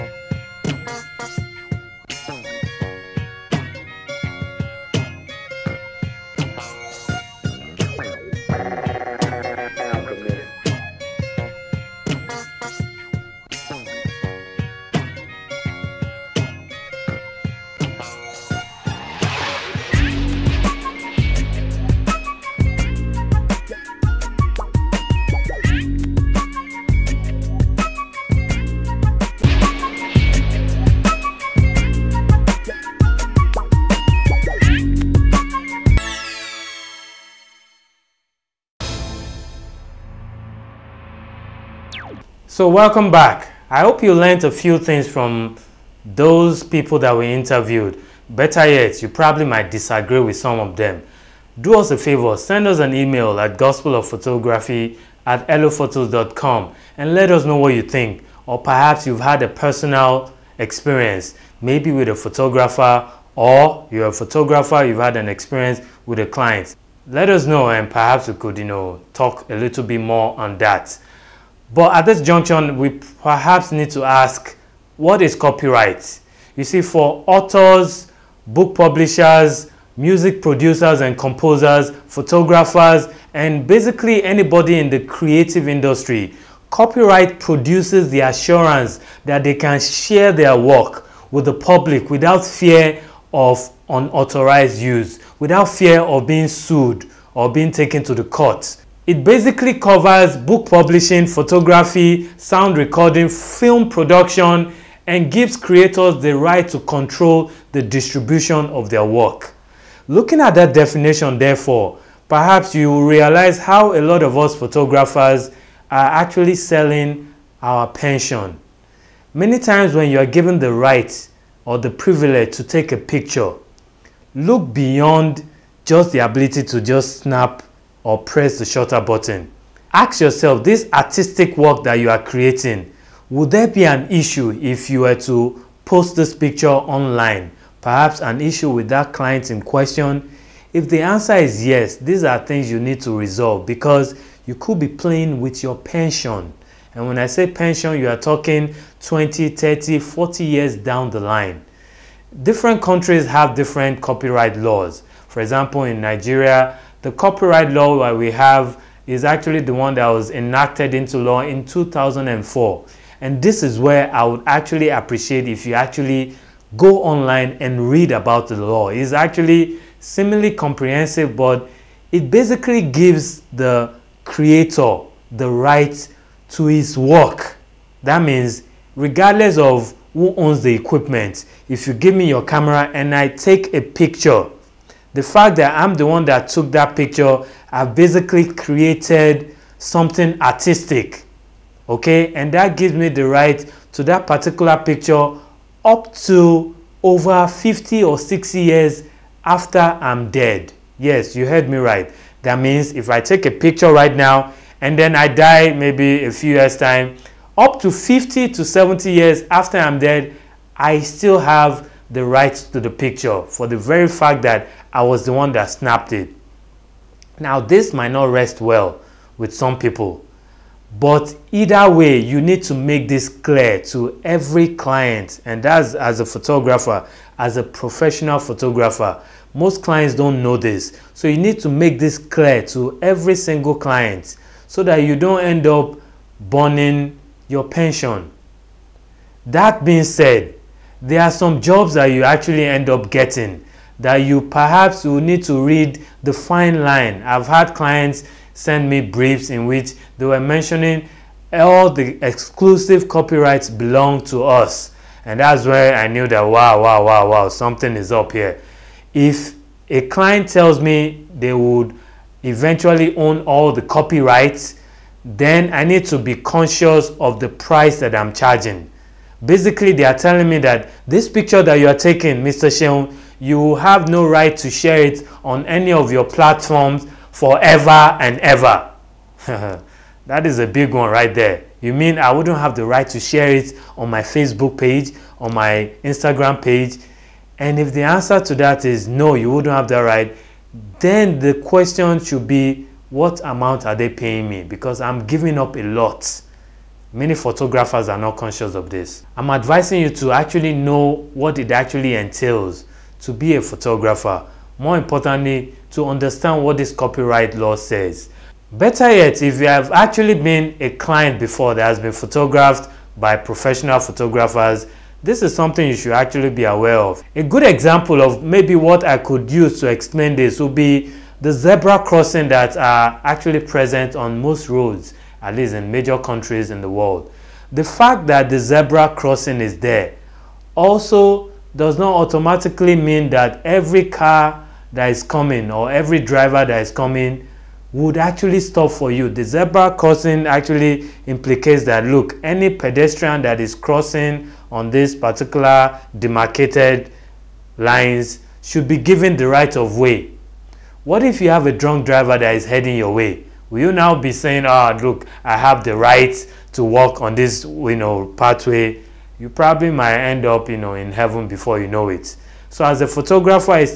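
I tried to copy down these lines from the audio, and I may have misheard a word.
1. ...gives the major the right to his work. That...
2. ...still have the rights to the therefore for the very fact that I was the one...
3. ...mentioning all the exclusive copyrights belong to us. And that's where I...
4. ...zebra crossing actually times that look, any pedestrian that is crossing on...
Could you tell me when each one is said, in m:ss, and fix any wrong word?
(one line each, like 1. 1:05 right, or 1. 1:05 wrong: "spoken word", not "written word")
1. 2:52 wrong: "creator", not "major"
2. 3:30 wrong: "picture", not "therefore"
3. 4:10 right
4. 5:39 wrong: "implicates", not "times".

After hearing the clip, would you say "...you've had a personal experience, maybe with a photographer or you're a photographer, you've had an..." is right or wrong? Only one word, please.
right.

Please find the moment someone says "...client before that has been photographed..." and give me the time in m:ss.
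5:10.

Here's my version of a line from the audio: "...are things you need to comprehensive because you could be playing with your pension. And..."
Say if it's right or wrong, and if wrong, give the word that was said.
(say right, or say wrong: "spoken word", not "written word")
wrong: "resolve", not "comprehensive".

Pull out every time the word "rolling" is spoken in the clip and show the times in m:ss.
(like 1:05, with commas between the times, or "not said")
not said.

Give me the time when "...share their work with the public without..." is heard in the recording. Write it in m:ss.
1:29.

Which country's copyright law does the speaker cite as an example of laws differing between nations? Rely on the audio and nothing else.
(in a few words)
Nigeria.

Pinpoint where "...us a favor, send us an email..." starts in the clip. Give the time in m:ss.
0:51.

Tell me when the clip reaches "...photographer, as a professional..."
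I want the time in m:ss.
3:46.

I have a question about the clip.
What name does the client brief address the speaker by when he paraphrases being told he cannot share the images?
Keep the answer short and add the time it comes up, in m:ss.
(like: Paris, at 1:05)
Mr. Seun, at 4:32.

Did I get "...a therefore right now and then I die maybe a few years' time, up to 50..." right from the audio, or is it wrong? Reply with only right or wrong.
wrong.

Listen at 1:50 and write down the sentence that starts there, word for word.
Looking at that definition, therefore, perhaps you will realize how a lot of us photographers are actually selling our pension.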